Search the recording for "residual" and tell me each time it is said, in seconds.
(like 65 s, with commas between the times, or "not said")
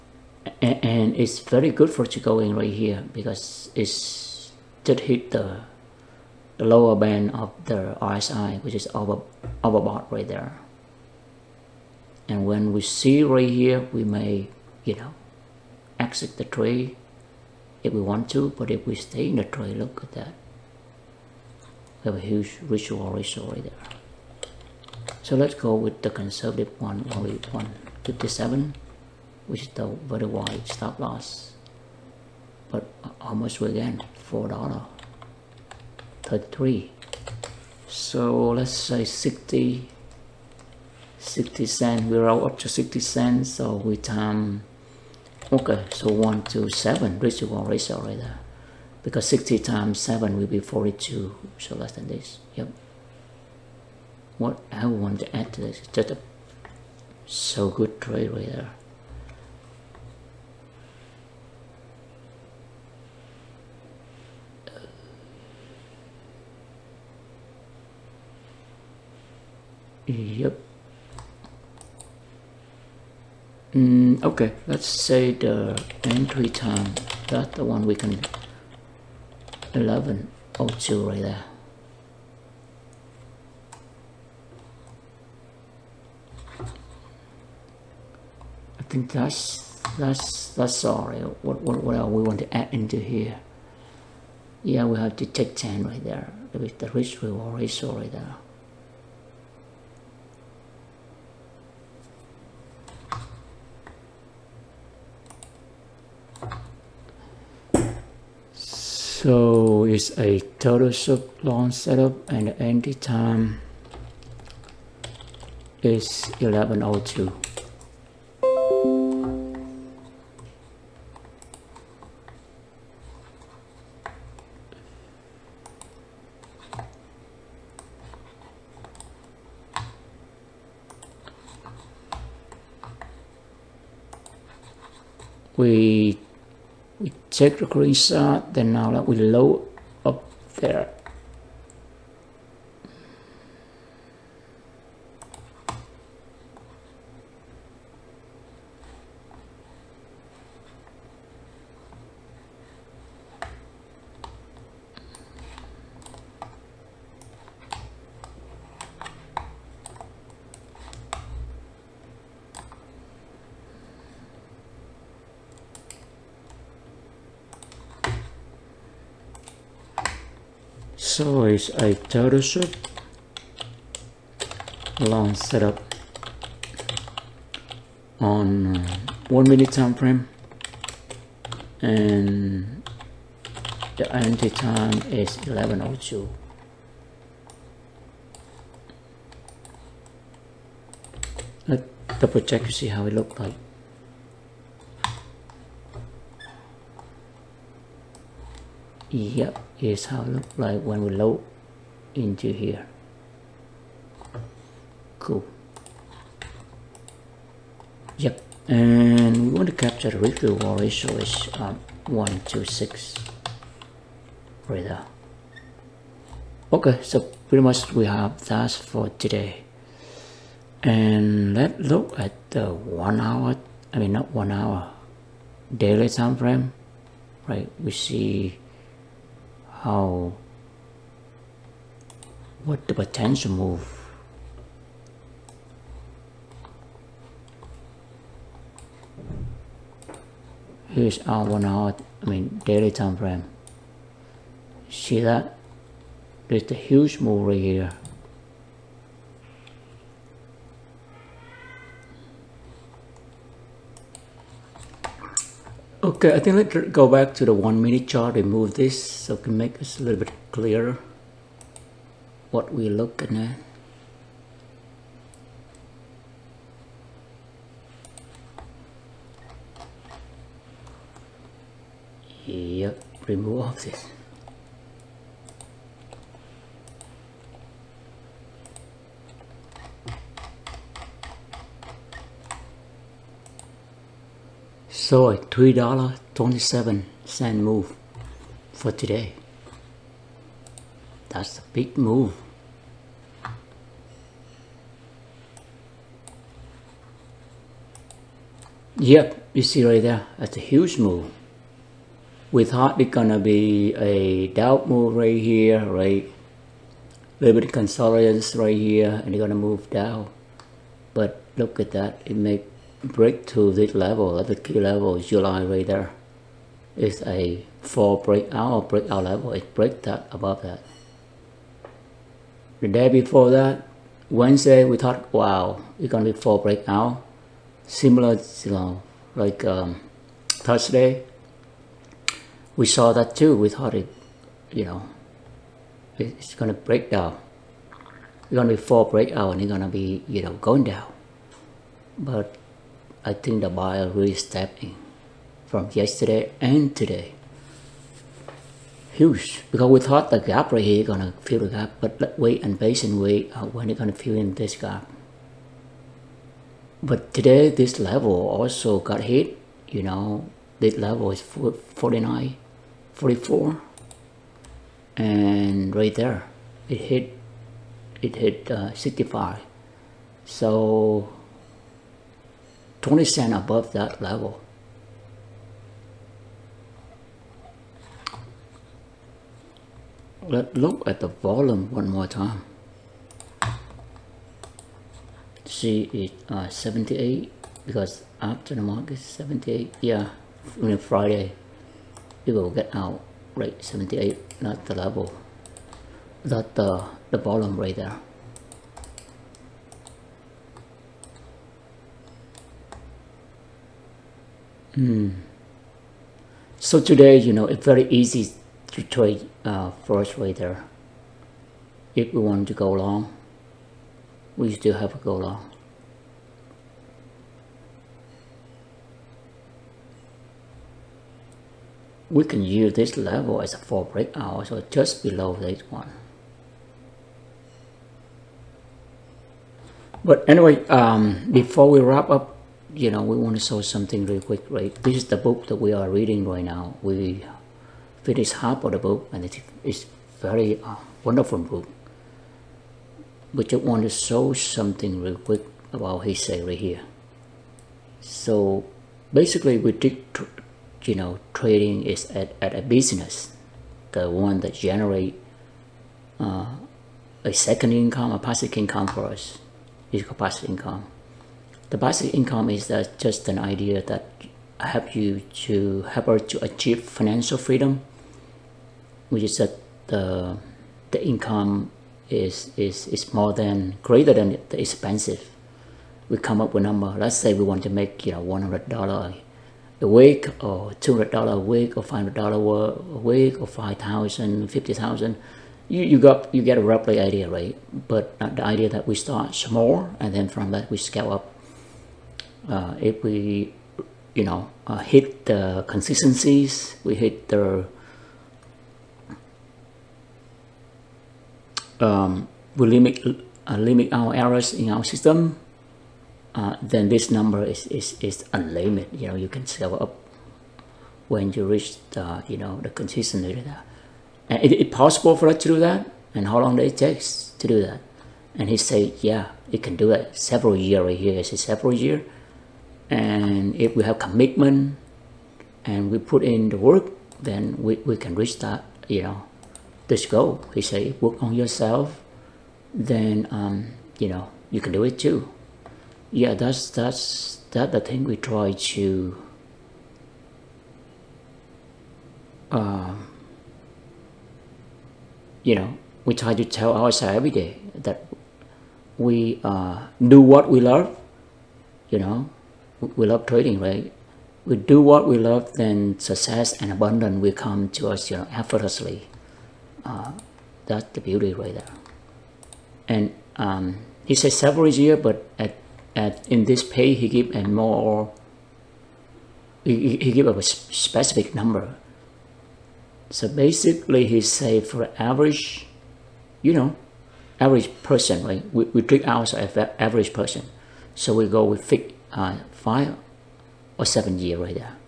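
47 s.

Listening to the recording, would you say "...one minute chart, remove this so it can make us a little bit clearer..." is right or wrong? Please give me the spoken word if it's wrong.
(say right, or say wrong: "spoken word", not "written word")
right.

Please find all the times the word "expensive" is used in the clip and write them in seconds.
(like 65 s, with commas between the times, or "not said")
474 s.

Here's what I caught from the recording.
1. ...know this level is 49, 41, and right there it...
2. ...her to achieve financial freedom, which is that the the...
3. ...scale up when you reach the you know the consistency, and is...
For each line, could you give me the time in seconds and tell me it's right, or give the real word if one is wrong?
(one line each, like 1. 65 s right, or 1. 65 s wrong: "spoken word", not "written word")
1. 360 s wrong: "44", not "41"
2. 466 s right
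3. 509 s right.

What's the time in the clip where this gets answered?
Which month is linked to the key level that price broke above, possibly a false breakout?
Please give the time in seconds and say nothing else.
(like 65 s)
315 s.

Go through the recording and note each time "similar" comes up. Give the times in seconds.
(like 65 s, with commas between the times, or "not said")
327 s.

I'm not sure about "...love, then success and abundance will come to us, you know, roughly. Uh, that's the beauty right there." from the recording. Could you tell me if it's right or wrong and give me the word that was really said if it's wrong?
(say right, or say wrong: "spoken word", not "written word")
wrong: "effortlessly", not "roughly".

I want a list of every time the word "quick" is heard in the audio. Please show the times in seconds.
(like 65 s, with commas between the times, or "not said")
434 s, 445 s.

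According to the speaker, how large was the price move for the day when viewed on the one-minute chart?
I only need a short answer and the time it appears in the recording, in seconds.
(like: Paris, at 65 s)
$3.27, at 285 s.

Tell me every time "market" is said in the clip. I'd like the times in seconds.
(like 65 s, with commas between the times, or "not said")
388 s.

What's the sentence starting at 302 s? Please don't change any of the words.
With hardly gonna be a doubt move right here, right?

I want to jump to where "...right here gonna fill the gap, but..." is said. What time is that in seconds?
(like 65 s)
350 s.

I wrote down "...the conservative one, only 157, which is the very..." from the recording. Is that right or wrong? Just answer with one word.
right.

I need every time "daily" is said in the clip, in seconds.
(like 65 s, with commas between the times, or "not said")
225 s, 242 s.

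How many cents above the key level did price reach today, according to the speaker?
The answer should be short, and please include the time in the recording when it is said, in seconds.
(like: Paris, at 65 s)
20 cents, at 373 s.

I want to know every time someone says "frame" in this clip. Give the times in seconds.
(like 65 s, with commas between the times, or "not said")
179 s, 226 s, 243 s.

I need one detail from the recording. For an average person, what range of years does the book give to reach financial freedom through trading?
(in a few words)
5 or 7 years.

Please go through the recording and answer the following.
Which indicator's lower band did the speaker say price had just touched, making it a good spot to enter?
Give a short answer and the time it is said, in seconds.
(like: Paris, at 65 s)
RSI, at 8 s.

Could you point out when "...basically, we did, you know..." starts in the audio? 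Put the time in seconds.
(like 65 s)
449 s.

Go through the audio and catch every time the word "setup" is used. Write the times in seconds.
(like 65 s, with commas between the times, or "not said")
111 s, 175 s.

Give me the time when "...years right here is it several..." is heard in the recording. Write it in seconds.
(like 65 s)
520 s.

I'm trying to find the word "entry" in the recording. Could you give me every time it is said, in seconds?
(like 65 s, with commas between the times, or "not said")
76 s, 112 s, 184 s.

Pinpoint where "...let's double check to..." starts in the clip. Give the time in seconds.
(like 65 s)
191 s.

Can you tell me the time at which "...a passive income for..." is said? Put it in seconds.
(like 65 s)
458 s.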